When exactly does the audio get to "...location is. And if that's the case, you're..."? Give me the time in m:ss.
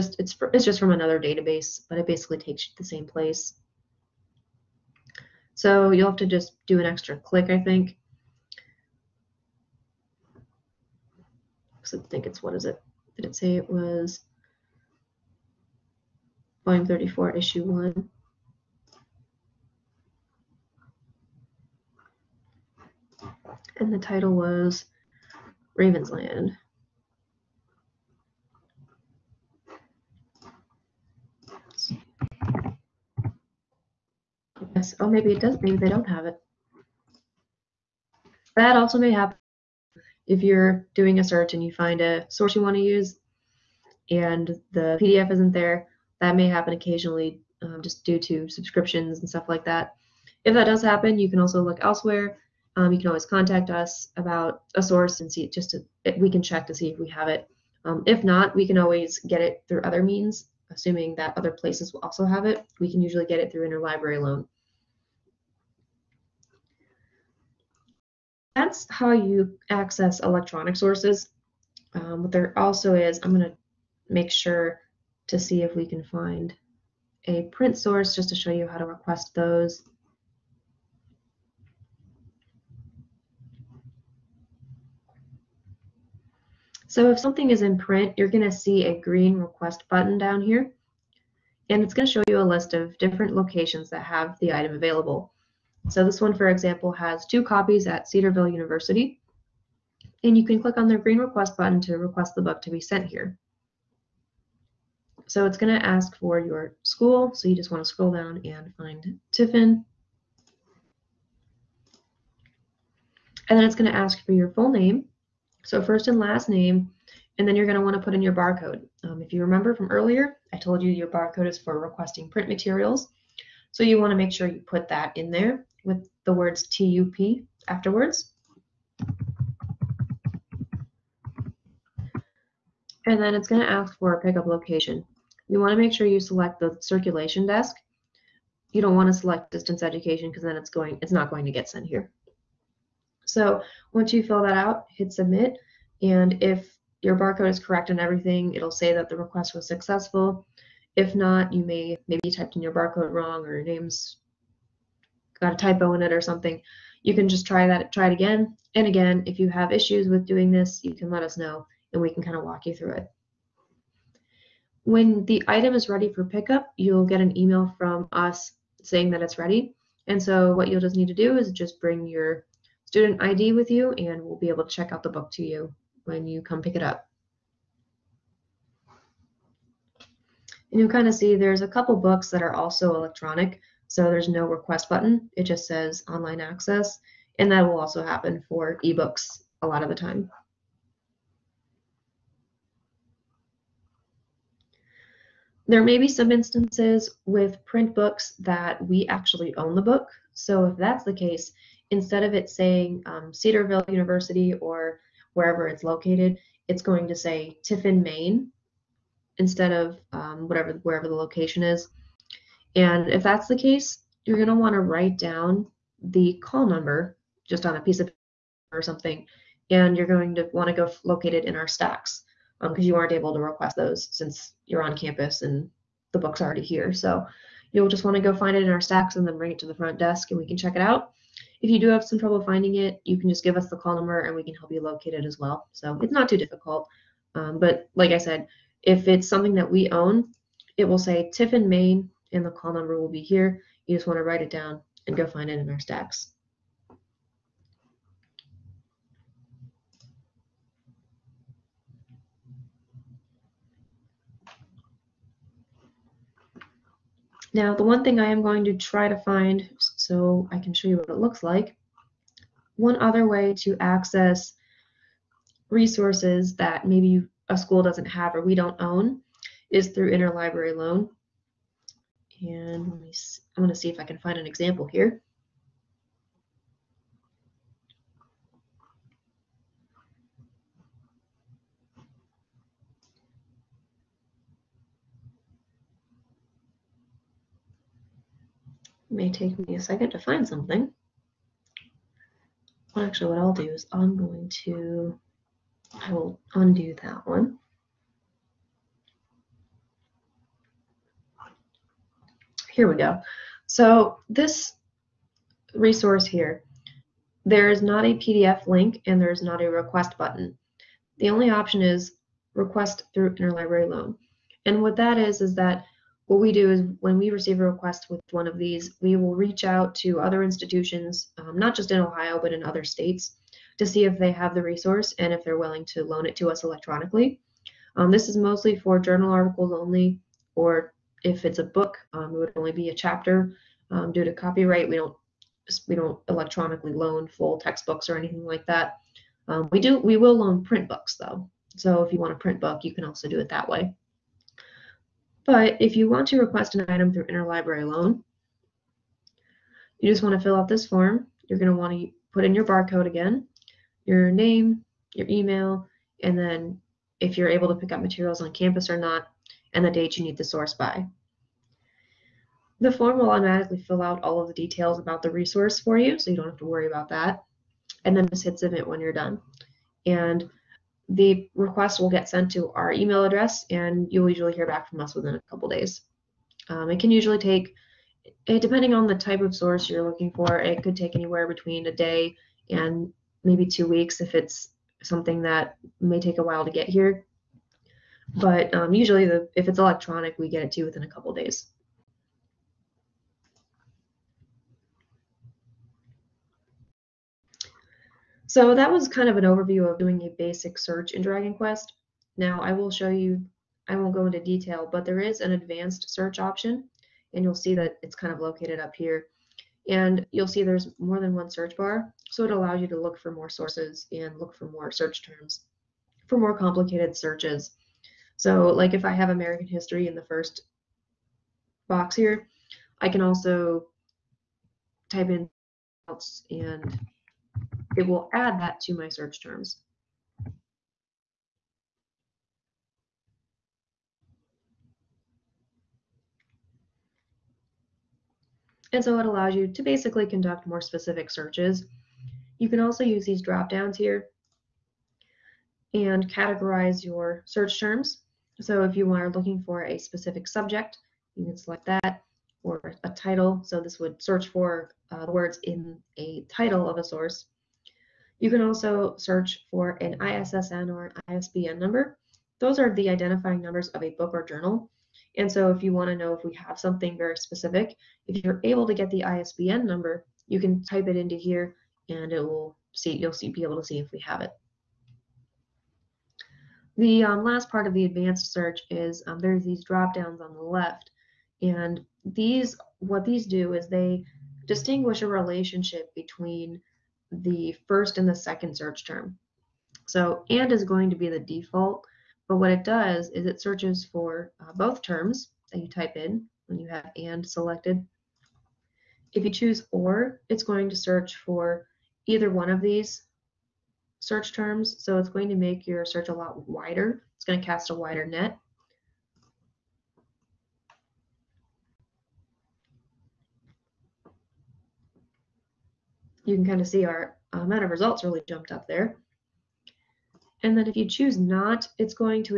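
3:31.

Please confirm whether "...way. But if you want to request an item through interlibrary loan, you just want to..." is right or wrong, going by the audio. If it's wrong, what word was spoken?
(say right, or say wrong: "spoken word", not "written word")
right.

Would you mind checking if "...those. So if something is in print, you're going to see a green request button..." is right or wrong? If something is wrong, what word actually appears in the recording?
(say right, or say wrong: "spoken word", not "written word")
right.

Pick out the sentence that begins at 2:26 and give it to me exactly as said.
And if your barcode is correct and everything, it'll say that the request was successful.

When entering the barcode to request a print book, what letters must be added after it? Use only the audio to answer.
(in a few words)
TUP.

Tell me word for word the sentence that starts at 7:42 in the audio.
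Those are the identifying numbers of a book or journal.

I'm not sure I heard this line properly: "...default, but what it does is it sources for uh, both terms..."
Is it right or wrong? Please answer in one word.
wrong.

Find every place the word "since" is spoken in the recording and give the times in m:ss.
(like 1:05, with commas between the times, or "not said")
3:44.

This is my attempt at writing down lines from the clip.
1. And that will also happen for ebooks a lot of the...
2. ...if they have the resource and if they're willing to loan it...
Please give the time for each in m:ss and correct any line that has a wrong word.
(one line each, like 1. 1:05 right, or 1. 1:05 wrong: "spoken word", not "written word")
1. 3:07 right
2. 5:24 right.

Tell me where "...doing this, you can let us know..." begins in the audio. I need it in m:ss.
2:40.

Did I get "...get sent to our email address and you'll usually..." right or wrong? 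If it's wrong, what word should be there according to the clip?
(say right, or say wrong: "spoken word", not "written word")
right.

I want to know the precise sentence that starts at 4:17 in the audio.
Now, the one thing I am going to try to find so I can show you what it looks like.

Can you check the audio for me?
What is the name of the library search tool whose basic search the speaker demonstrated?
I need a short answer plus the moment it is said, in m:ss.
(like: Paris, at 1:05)
Dragon Quest, at 6:41.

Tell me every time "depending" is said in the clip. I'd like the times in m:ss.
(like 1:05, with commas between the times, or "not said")
6:18.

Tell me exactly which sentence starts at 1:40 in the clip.
And you can click on the green request button to request the book to be sent here.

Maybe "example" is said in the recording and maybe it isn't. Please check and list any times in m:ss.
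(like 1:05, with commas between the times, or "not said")
1:36, 4:34.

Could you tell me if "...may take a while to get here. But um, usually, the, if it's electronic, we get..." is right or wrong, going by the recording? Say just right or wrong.
right.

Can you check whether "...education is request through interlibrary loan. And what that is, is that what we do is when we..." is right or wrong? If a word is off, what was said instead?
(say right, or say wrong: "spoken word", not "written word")
wrong: "option", not "education".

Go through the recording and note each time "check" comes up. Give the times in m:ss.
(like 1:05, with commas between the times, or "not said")
0:56, 2:54, 3:50.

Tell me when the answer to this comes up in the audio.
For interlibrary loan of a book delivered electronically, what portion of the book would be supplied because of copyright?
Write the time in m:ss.
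5:32.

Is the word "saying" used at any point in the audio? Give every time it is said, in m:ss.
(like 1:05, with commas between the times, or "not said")
2:48, 3:22.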